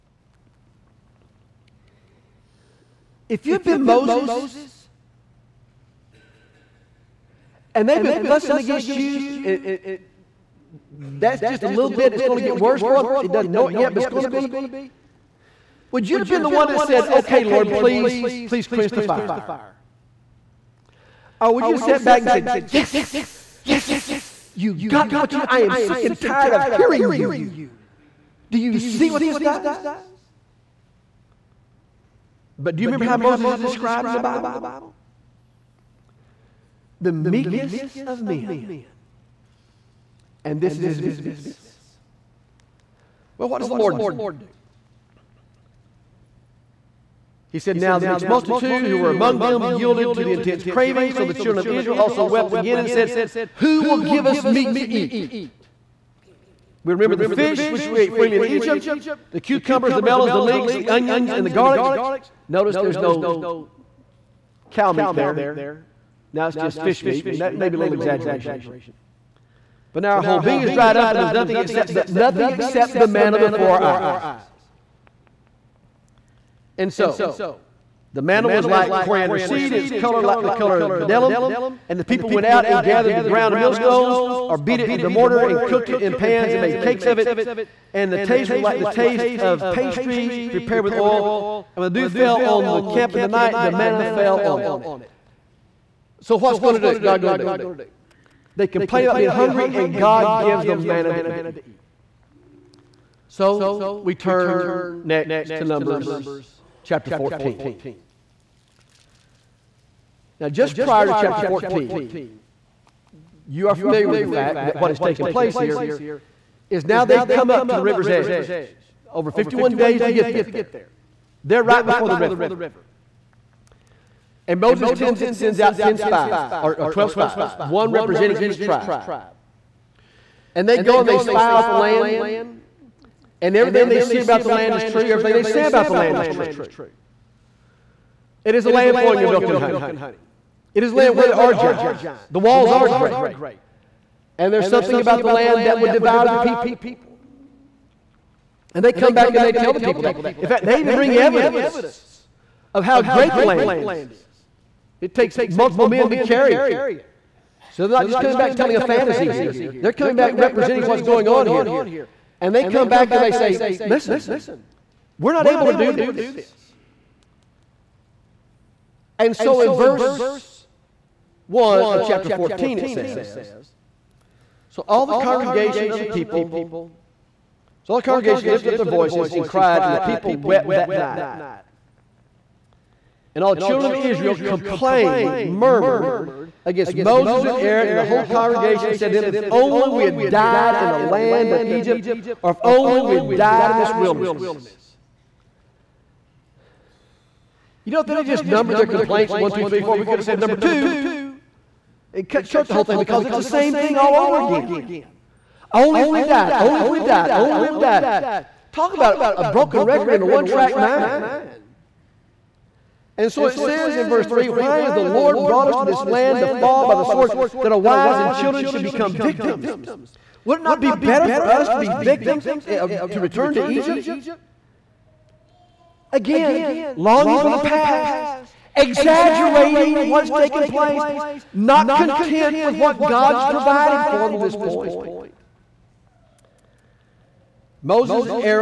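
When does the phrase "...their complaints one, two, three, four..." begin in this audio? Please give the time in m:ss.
3:18.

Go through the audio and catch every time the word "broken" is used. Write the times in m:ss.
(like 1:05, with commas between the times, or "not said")
3:29.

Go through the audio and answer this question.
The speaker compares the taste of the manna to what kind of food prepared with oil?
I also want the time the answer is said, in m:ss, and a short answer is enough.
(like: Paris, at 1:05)
pastry, at 1:29.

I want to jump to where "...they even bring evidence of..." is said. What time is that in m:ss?
2:30.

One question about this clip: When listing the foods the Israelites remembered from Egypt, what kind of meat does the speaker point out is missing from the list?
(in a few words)
cow meat.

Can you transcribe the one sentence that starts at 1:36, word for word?
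So what's going to do, God going to do?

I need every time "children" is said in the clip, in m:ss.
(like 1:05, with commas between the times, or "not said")
0:51, 3:03, 3:38.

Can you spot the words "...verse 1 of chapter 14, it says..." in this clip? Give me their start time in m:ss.
2:49.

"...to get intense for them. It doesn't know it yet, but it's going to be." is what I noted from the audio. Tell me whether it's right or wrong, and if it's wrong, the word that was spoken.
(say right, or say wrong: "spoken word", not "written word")
wrong: "worse", not "intense".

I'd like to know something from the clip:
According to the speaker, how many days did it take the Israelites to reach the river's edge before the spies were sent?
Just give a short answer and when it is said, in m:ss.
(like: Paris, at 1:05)
51, at 1:59.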